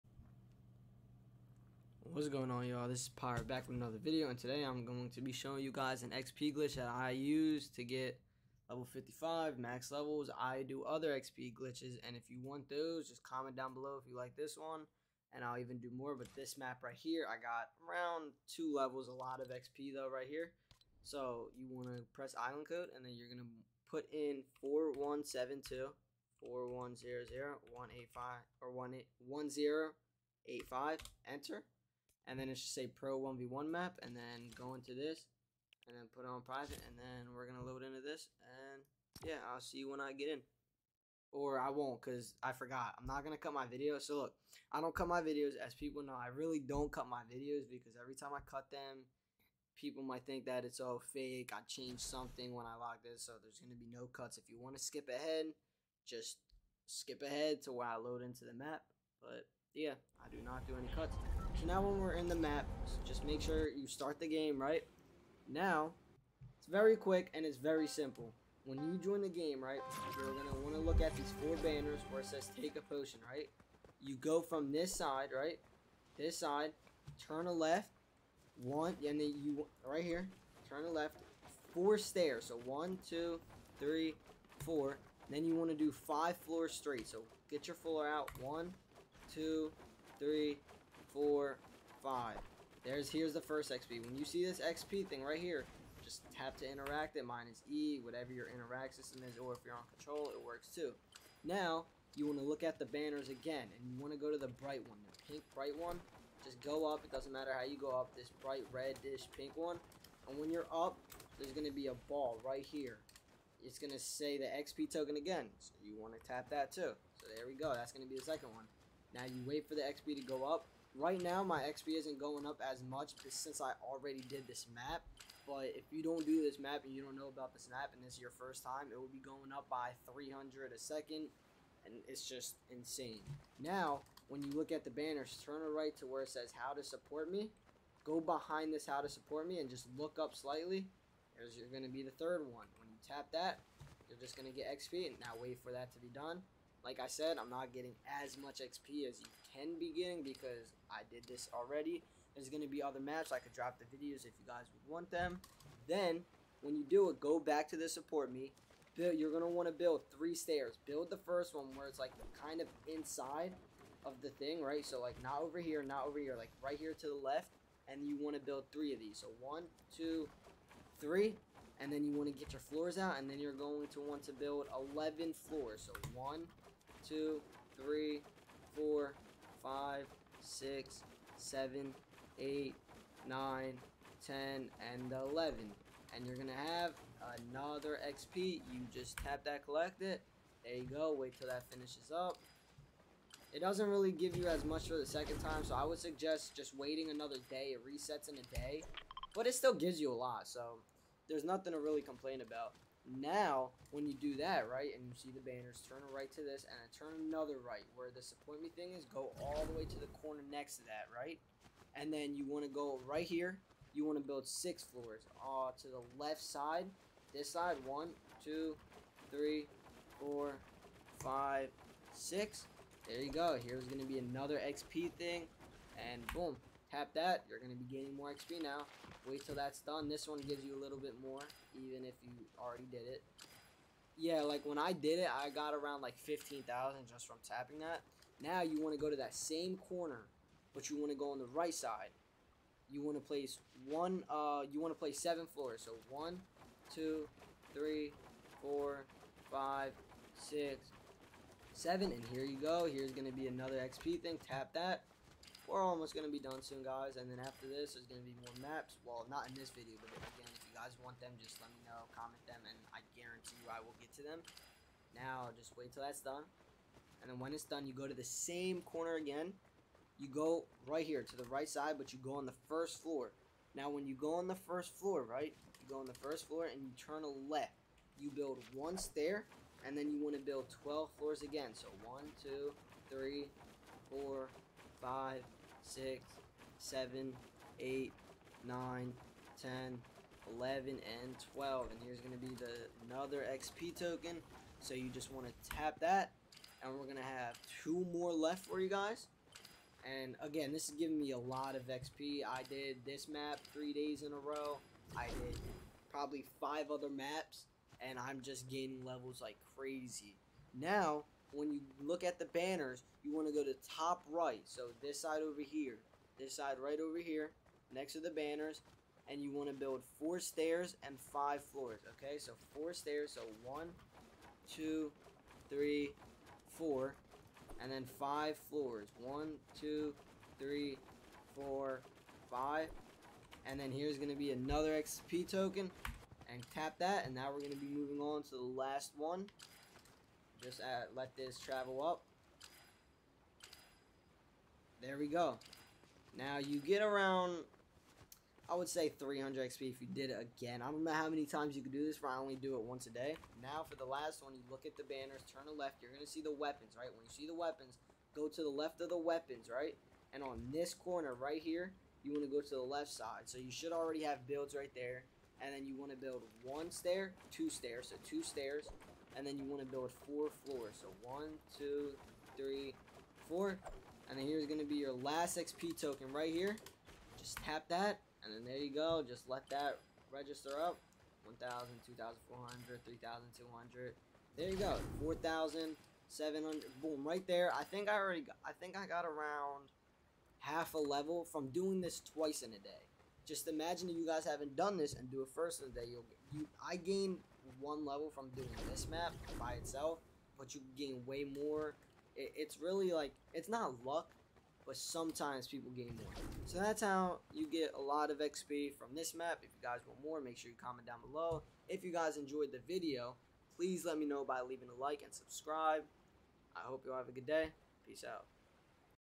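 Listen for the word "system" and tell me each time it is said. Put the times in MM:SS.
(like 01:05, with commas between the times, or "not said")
01:38.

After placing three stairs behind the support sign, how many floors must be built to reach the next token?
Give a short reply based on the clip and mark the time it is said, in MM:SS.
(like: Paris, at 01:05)
11, at 02:54.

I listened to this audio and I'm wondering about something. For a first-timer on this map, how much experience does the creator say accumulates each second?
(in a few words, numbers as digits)
300.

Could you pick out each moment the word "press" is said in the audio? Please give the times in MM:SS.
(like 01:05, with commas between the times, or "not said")
00:22.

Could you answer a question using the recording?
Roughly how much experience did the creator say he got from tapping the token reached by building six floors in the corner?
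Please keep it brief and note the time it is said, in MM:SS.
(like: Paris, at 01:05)
15,000, at 03:56.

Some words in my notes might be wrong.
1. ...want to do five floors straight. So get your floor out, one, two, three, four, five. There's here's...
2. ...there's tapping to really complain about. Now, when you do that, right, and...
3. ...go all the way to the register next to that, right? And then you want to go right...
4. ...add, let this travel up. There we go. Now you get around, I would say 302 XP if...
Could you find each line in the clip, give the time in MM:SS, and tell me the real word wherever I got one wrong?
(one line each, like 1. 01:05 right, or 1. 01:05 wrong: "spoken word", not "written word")
1. 01:25 right
2. 03:21 wrong: "nothing", not "tapping"
3. 03:29 wrong: "corner", not "register"
4. 05:40 wrong: "300", not "302".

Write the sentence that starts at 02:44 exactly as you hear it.
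So like not over here, not over here, like right here to the left.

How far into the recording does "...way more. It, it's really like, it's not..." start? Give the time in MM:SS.
06:41.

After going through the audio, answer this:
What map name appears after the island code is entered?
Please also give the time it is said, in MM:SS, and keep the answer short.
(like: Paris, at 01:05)
pro 1v1 map, at 00:32.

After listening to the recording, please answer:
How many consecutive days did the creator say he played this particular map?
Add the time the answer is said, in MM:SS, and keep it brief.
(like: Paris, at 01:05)
3, at 05:03.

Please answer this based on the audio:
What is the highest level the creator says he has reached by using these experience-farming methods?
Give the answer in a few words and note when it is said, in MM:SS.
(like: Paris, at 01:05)
55, at 00:08.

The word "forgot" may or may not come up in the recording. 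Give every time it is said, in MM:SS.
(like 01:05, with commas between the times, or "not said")
00:42.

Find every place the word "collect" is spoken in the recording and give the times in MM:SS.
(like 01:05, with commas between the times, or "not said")
03:09.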